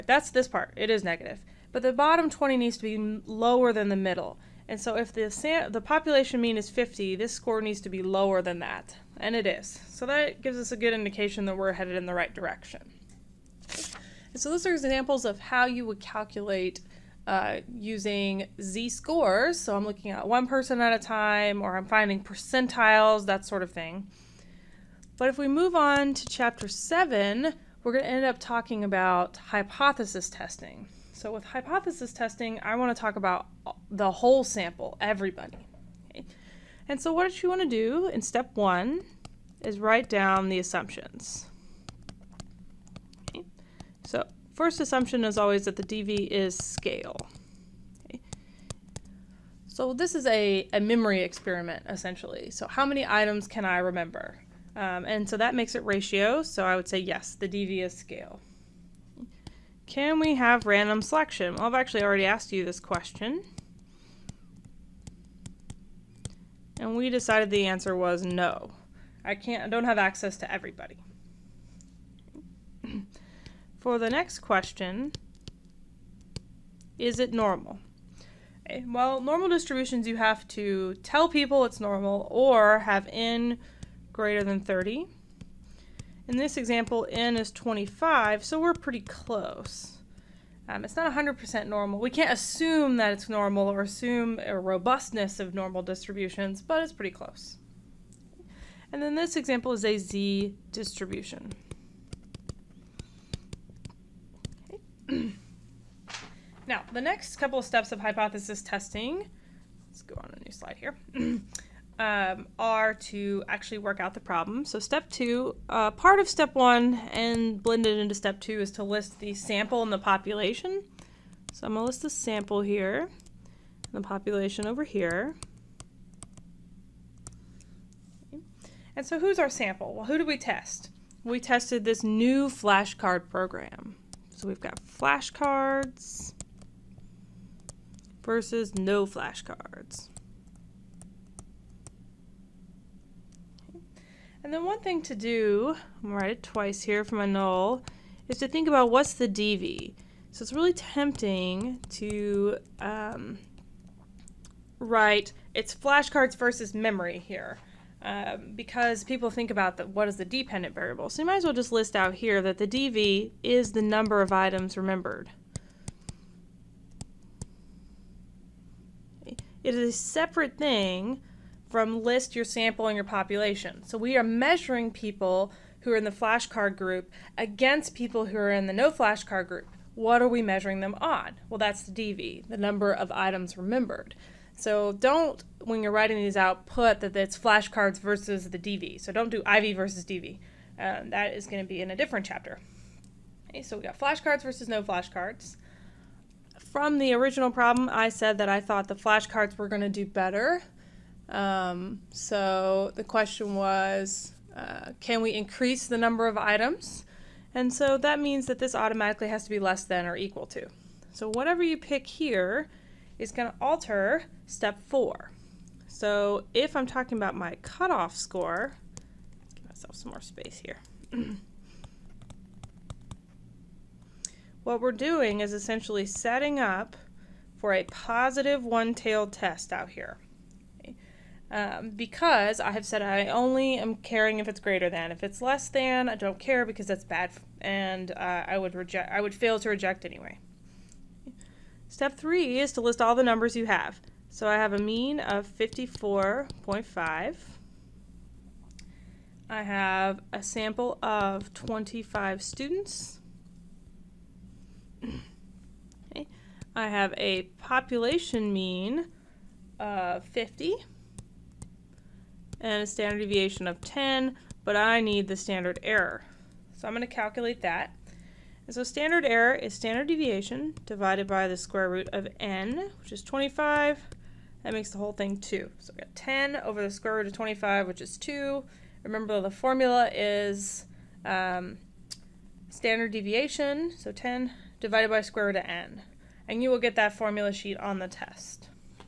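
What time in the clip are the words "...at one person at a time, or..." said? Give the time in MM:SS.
00:20.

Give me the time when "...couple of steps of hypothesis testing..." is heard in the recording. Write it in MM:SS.
01:47.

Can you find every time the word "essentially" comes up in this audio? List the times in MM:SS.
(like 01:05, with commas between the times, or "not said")
00:51, 03:45.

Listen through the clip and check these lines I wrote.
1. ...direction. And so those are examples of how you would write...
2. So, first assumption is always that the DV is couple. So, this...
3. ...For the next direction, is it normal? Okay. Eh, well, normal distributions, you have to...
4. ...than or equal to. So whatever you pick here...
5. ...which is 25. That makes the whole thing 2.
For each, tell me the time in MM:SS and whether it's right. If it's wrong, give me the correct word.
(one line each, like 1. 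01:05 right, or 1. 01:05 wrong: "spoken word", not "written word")
1. 00:12 wrong: "calculate", not "write"
2. 00:44 wrong: "scale", not "couple"
3. 01:13 wrong: "question", not "direction"
4. 03:29 right
5. 04:33 right.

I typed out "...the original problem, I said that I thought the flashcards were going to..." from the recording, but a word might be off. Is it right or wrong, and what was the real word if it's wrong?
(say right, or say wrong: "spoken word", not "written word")
right.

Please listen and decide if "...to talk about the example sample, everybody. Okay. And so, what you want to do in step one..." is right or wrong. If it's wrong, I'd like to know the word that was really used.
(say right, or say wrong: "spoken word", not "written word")
wrong: "whole", not "example".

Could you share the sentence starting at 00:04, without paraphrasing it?
And so if the, sam- the population mean is 50, this score needs to be lower than that.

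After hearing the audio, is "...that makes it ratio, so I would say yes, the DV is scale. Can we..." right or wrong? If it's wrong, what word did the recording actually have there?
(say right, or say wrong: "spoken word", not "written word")
right.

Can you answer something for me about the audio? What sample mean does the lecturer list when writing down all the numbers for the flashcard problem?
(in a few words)
54.5.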